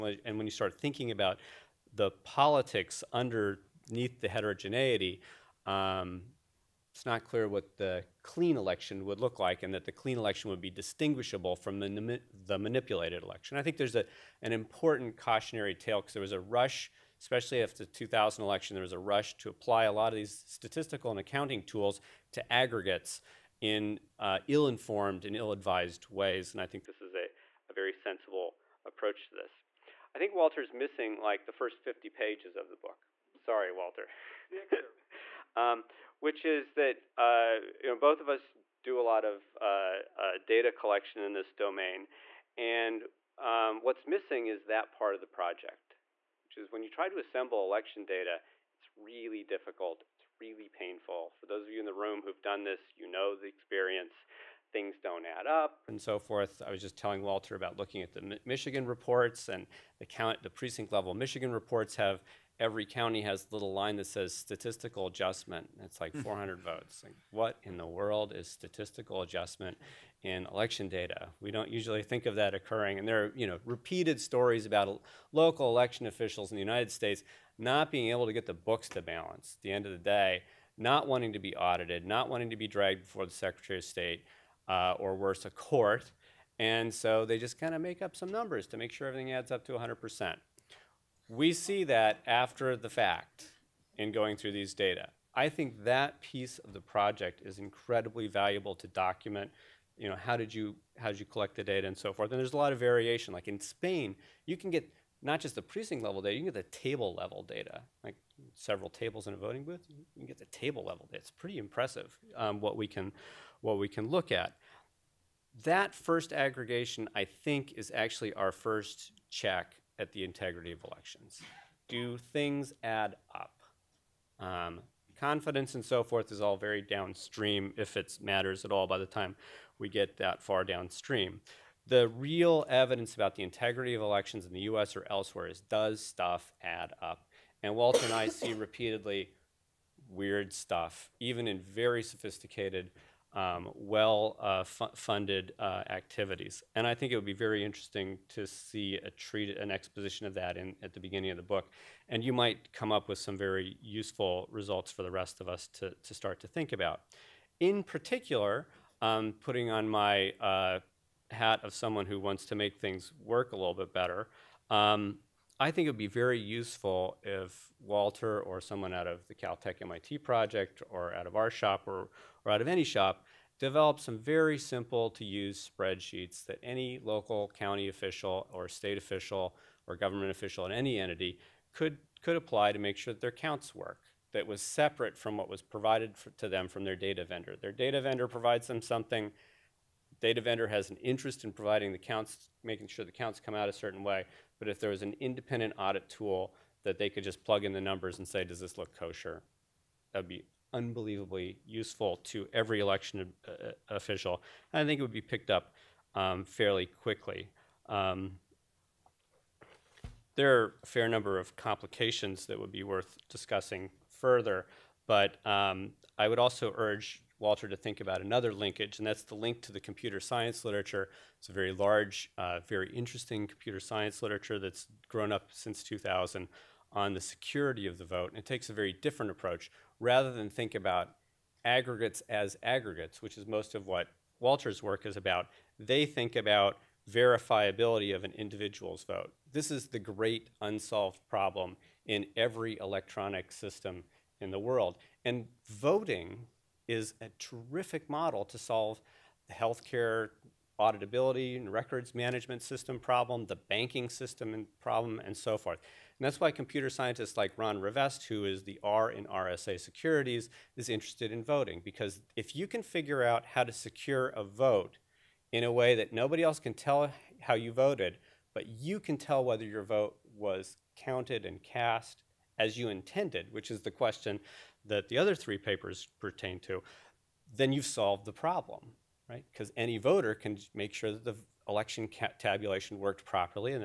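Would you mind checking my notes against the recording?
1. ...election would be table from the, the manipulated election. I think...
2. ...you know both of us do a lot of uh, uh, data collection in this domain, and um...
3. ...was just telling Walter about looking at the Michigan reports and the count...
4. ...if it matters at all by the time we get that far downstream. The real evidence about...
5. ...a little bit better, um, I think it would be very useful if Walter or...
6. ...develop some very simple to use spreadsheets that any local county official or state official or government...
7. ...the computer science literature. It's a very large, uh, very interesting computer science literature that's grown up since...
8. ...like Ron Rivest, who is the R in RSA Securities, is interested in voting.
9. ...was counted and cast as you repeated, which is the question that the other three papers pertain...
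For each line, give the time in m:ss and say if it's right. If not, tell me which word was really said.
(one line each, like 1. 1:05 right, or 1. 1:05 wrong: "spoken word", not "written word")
1. 0:10 wrong: "distinguishable", not "table"
2. 0:37 right
3. 0:56 right
4. 2:07 right
5. 2:43 right
6. 2:53 right
7. 3:39 right
8. 4:17 right
9. 4:30 wrong: "intended", not "repeated".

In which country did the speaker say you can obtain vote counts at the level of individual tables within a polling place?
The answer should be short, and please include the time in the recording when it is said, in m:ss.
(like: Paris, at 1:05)
Spain, at 1:43.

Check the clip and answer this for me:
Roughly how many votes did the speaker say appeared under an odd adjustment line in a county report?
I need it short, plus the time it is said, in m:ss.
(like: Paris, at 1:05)
400, at 1:06.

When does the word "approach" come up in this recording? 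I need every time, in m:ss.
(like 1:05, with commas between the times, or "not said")
0:28, 3:49.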